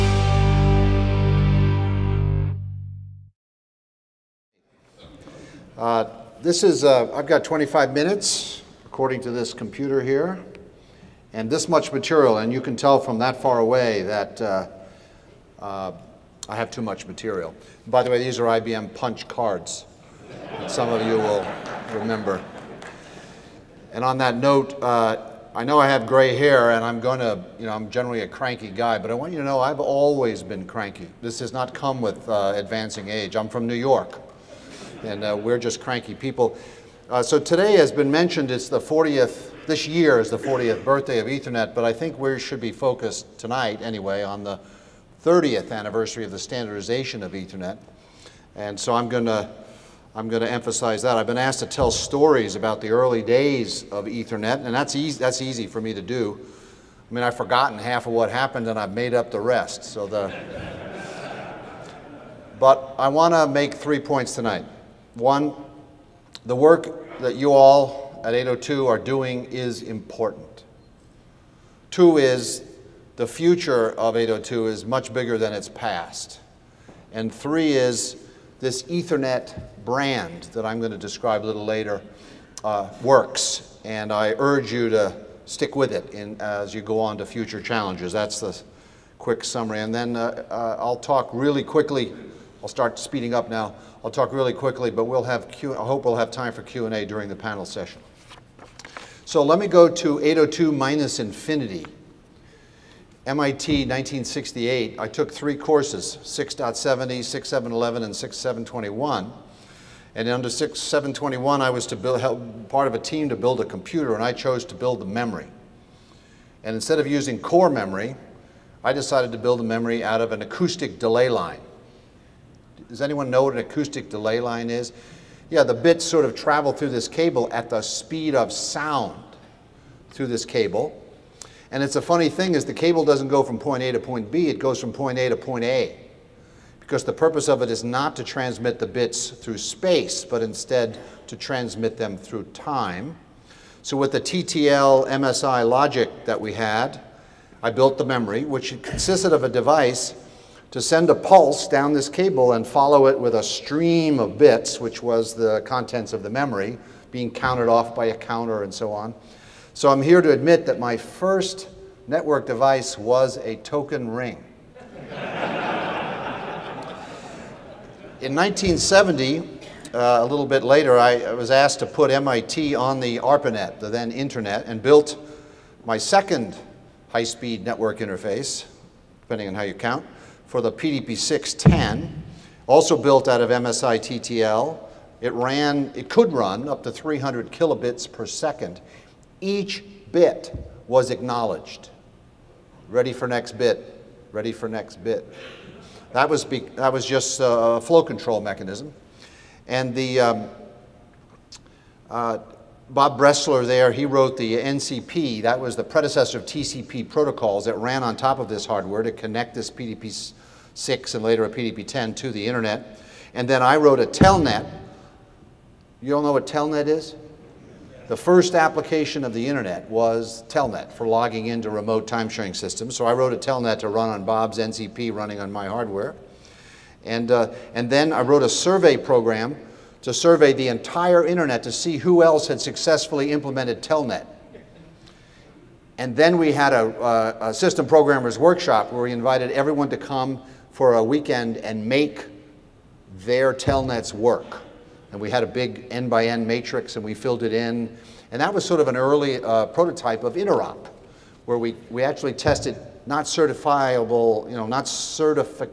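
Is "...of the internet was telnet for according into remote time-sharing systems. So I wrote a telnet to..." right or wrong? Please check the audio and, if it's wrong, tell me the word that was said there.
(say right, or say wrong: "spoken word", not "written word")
wrong: "logging", not "according".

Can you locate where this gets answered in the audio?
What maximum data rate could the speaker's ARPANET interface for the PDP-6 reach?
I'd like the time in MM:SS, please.
03:06.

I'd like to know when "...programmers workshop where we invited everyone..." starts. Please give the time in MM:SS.
03:57.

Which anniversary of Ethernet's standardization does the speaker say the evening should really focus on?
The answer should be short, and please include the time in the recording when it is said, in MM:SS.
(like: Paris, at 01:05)
30th, at 00:45.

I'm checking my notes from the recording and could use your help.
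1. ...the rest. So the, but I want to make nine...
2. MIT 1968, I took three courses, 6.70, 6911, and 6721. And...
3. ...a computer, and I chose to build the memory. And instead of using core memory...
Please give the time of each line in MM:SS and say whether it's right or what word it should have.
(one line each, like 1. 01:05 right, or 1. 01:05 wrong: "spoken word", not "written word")
1. 00:59 wrong: "three", not "nine"
2. 01:43 wrong: "6711", not "6911"
3. 01:53 right.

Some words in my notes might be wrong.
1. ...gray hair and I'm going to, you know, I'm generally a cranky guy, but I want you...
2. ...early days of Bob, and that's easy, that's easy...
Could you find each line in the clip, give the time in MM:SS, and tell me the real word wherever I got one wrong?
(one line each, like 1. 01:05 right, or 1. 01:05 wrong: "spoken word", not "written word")
1. 00:26 right
2. 00:52 wrong: "Ethernet", not "Bob".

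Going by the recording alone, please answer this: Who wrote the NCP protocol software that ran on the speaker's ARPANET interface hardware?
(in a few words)
Bob Bressler.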